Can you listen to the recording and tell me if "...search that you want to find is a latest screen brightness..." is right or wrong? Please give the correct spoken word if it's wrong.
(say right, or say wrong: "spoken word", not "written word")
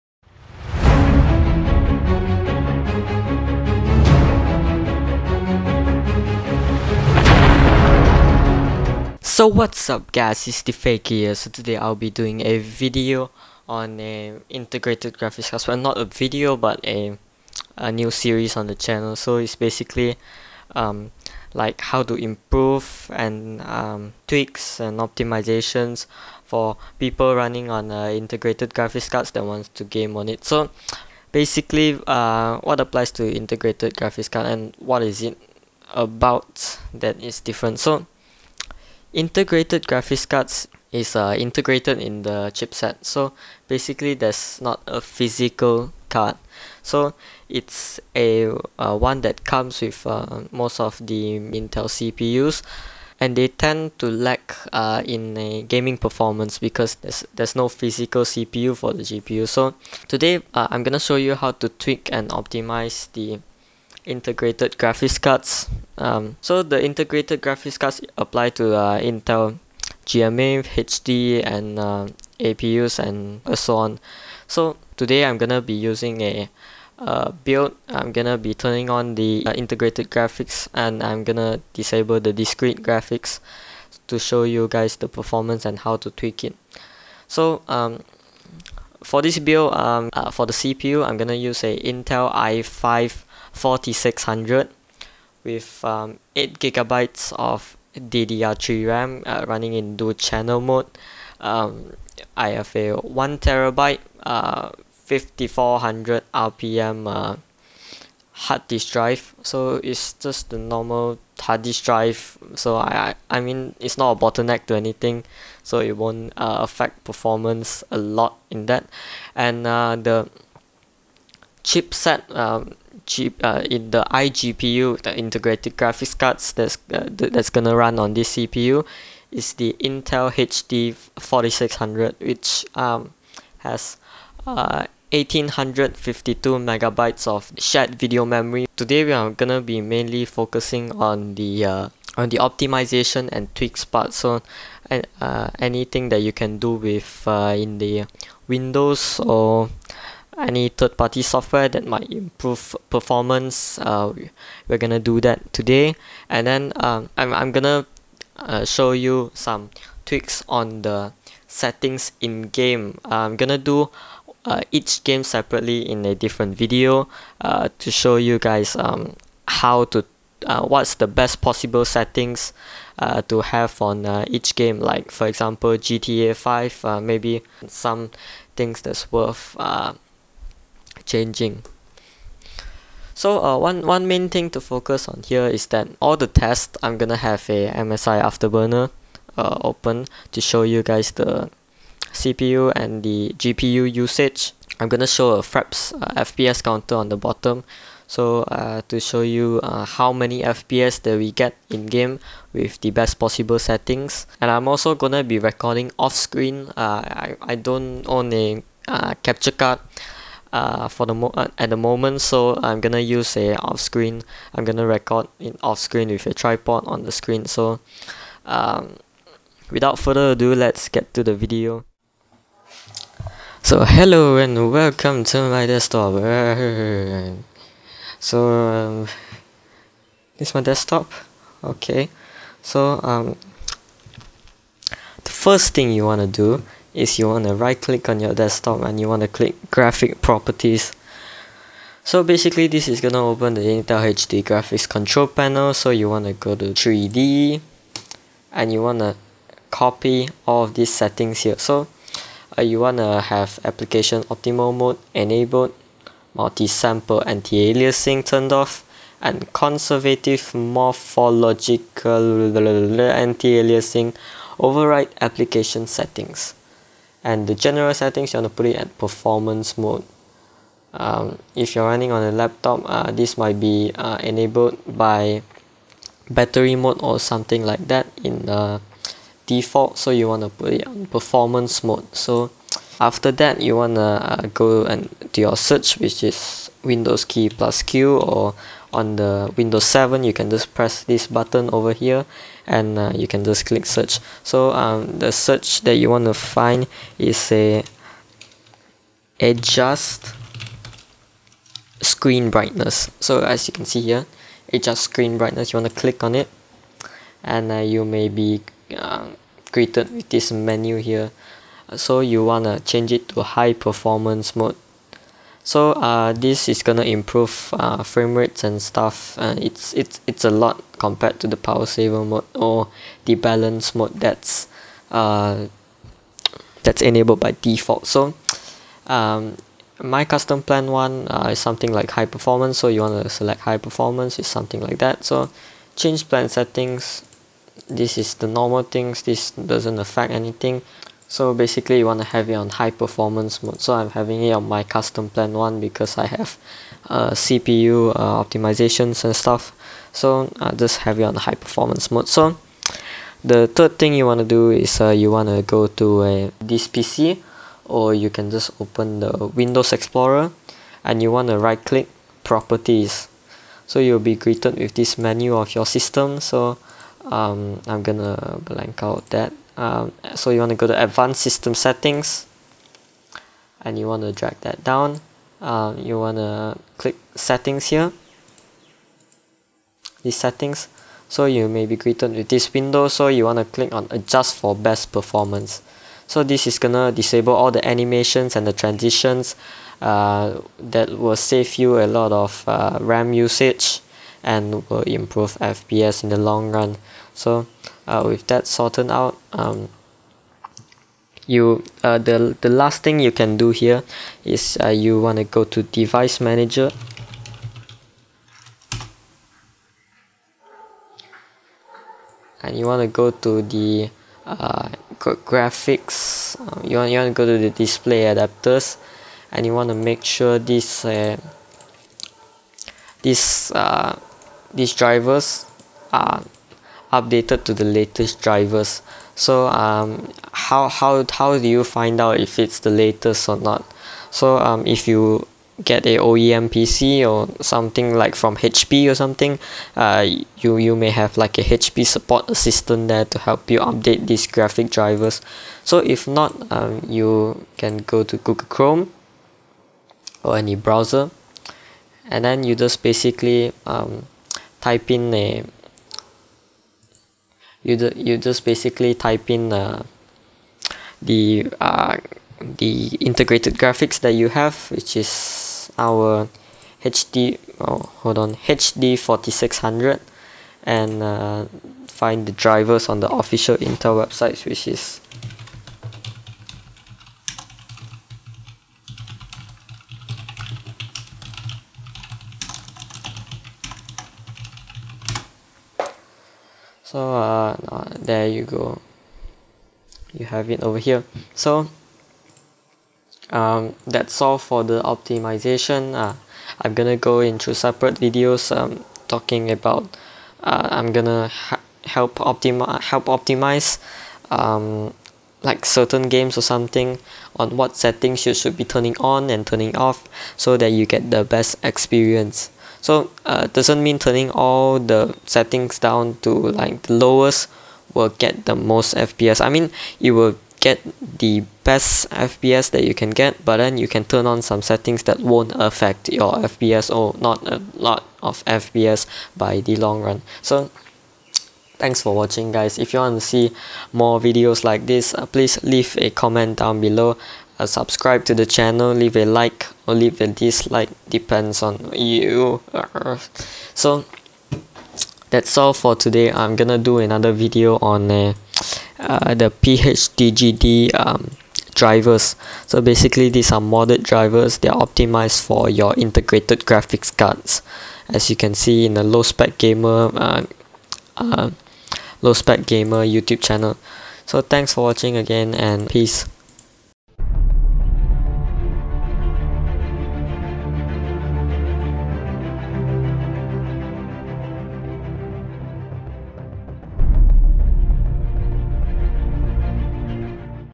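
wrong: "adjust", not "latest".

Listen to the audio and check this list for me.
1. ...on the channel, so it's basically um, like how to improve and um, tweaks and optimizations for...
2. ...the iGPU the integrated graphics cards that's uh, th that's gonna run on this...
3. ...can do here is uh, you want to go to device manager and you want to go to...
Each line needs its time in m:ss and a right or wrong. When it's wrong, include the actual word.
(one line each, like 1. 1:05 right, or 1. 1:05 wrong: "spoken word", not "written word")
1. 0:18 right
2. 2:03 right
3. 6:43 right.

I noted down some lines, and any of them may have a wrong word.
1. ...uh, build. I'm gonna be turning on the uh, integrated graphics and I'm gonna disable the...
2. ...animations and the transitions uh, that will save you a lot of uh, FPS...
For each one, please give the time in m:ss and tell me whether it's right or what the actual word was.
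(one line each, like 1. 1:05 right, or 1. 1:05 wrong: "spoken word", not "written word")
1. 1:16 right
2. 6:27 wrong: "RAM", not "FPS".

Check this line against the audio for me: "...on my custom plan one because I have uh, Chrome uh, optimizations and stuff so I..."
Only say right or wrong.
wrong.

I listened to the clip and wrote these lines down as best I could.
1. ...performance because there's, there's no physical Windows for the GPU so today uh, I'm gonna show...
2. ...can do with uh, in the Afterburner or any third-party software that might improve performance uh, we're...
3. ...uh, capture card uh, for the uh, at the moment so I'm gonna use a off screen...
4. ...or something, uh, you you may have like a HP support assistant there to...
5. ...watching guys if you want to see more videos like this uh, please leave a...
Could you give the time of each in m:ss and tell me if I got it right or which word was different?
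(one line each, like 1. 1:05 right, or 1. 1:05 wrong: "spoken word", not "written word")
1. 0:55 wrong: "CPU", not "Windows"
2. 2:26 wrong: "Windows", not "Afterburner"
3. 3:28 right
4. 7:19 right
5. 8:52 right.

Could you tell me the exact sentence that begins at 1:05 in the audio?
Um, so the integrated graphics cards apply to uh, Intel GMA, HD, and uh, APUs and so on.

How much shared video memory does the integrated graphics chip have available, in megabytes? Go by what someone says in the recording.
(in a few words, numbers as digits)
1852.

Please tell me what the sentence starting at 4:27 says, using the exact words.
And the general settings, you want to put it at performance mode.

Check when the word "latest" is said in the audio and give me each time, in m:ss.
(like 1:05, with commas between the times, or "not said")
7:07, 7:12.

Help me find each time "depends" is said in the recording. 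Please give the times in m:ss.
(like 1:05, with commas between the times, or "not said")
9:01.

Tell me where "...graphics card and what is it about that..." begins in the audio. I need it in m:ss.
0:33.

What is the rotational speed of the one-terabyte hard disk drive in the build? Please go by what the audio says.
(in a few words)
5400 RPM.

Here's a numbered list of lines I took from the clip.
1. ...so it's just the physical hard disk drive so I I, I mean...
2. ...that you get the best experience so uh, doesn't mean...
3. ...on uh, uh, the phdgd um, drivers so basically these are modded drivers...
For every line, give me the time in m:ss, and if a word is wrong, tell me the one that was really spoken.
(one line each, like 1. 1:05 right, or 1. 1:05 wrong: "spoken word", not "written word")
1. 1:49 wrong: "normal", not "physical"
2. 8:30 right
3. 9:07 right.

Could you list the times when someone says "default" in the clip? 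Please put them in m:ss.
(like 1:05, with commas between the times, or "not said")
4:39, 5:27.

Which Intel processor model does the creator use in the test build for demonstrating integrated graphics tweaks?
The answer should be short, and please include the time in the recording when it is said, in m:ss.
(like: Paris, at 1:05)
i5 4600, at 1:32.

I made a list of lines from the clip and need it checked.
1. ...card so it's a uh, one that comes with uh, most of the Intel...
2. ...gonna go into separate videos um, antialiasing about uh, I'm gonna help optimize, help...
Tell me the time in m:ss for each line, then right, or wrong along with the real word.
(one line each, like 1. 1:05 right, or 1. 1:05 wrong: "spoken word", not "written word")
1. 0:46 right
2. 8:16 wrong: "talking", not "antialiasing".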